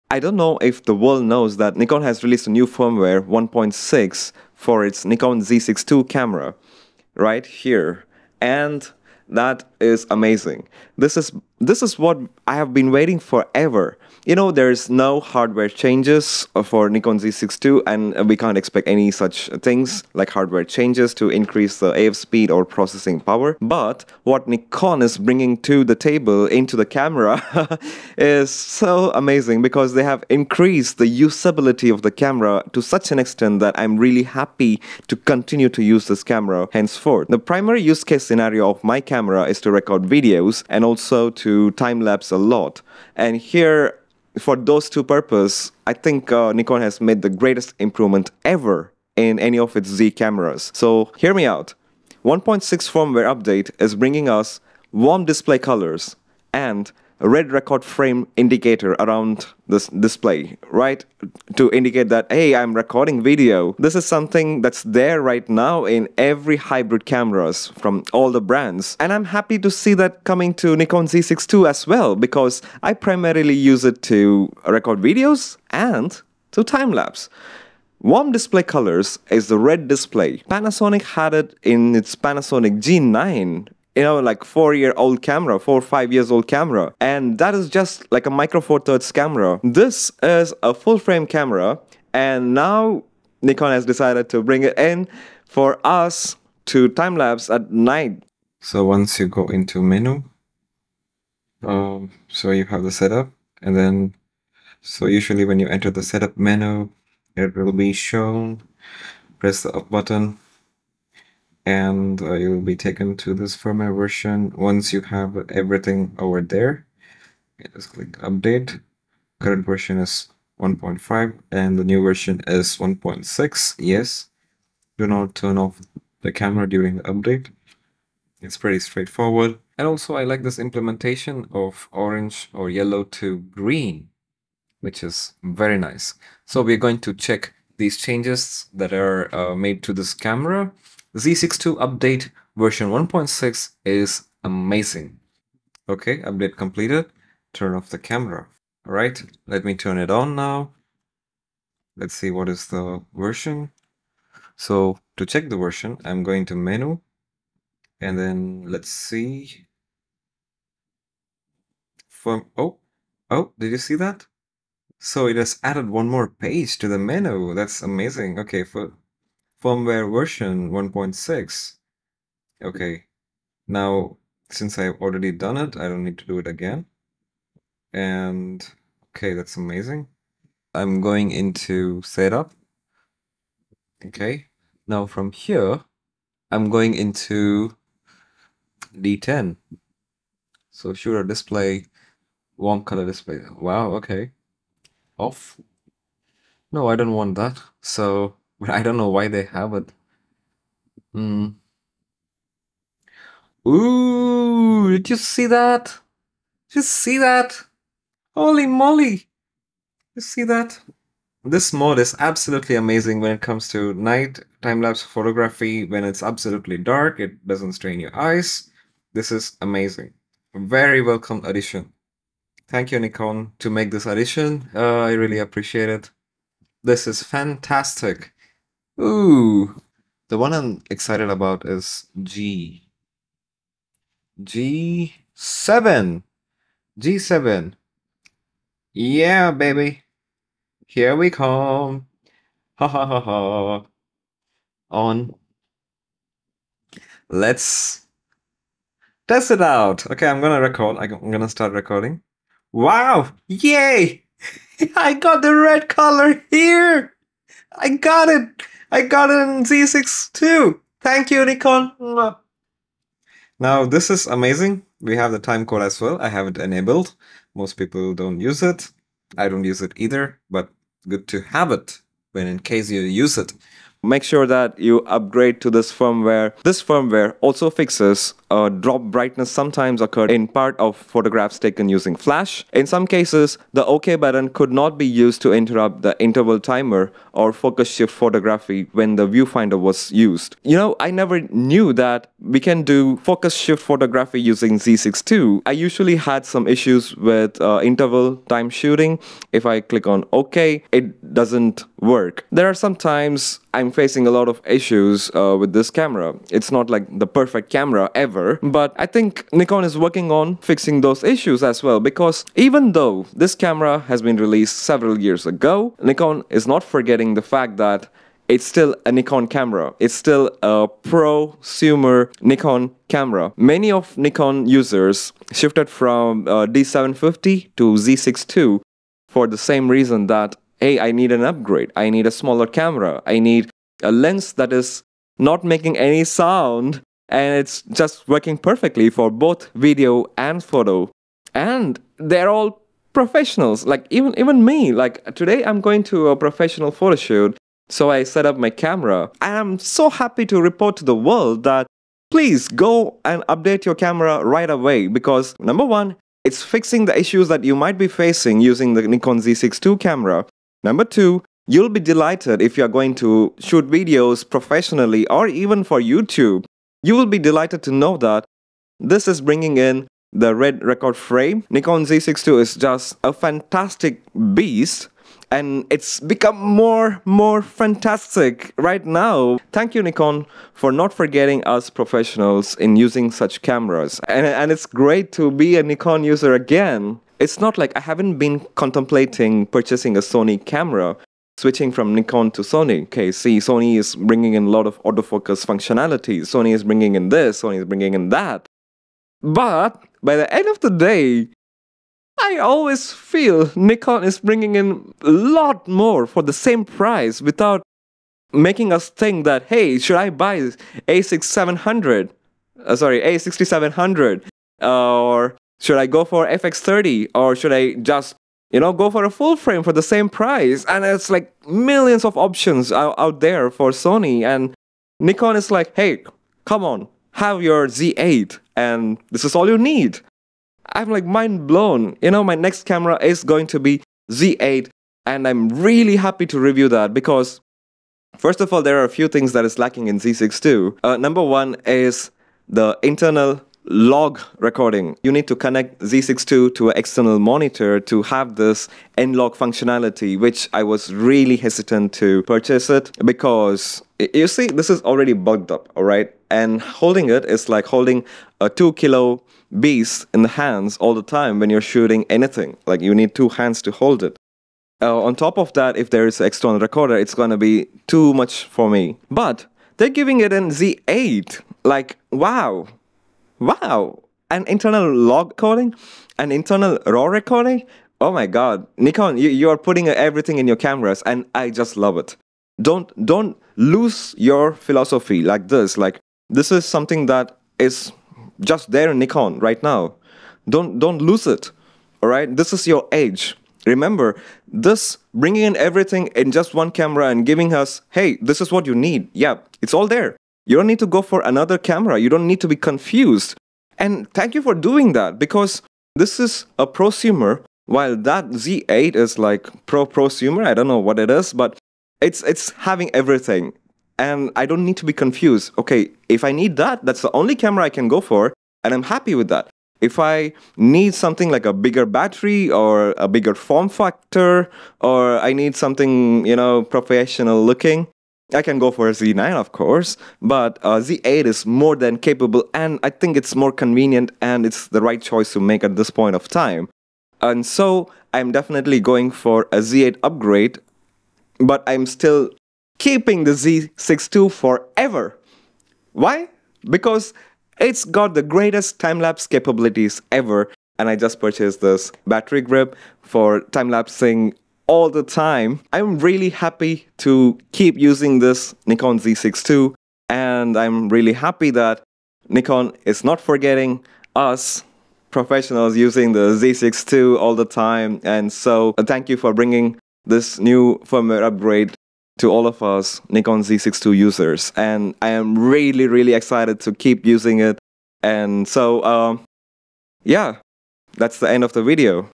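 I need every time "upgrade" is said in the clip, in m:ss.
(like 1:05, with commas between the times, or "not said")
4:35, 5:31, 9:00, 9:31.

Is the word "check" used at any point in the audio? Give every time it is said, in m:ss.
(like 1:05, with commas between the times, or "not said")
2:17, 2:35.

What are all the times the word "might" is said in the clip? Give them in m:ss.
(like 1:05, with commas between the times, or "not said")
5:57.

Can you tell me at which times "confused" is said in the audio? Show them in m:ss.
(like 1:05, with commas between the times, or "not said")
8:22, 8:35.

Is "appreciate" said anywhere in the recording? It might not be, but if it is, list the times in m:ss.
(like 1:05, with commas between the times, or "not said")
3:45.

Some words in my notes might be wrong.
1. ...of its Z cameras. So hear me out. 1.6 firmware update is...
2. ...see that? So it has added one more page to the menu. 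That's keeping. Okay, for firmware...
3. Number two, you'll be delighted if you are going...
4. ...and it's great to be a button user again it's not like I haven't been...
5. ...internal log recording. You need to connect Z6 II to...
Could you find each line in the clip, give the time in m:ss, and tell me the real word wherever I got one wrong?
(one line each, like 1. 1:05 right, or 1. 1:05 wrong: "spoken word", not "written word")
1. 0:49 right
2. 2:43 wrong: "amazing", not "keeping"
3. 6:00 right
4. 6:24 wrong: "nikon", not "button"
5. 7:23 right.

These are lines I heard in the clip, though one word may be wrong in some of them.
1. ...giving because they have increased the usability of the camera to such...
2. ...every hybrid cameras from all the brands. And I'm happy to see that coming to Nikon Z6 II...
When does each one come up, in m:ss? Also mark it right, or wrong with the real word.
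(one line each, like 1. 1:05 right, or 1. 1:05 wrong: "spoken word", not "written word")
1. 0:29 wrong: "amazing", not "giving"
2. 1:06 right.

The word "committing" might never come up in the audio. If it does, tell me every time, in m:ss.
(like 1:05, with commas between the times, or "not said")
not said.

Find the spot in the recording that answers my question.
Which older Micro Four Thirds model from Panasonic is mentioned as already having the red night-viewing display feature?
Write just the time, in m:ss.
1:22.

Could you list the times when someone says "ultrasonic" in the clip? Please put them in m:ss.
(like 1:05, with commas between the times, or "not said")
not said.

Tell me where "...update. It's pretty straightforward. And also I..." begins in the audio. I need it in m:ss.
2:07.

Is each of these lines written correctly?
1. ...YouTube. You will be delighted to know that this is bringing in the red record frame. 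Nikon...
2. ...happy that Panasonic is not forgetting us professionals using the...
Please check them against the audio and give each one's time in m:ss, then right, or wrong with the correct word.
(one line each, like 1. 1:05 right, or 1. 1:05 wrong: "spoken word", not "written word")
1. 6:06 right
2. 9:21 wrong: "Nikon", not "Panasonic".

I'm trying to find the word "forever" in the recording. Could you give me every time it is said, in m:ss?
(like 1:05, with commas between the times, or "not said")
0:13, 9:04.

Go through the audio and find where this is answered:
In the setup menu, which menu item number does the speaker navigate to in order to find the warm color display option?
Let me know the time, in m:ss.
3:08.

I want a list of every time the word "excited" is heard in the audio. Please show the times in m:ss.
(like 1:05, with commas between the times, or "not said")
3:50, 9:36.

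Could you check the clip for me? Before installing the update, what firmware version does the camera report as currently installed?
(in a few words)
1.5.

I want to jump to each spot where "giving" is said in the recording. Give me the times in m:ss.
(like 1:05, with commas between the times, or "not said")
7:50, 8:17.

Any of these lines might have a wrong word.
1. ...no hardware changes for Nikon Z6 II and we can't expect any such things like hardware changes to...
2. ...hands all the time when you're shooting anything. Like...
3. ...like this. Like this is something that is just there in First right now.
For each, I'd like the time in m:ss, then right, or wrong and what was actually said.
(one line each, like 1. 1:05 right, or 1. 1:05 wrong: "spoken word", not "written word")
1. 0:14 right
2. 7:40 right
3. 8:05 wrong: "Nikon", not "First".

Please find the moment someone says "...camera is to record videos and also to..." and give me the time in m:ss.
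0:39.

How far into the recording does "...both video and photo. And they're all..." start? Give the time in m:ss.
5:39.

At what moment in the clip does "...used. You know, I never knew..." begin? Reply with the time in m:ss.
4:50.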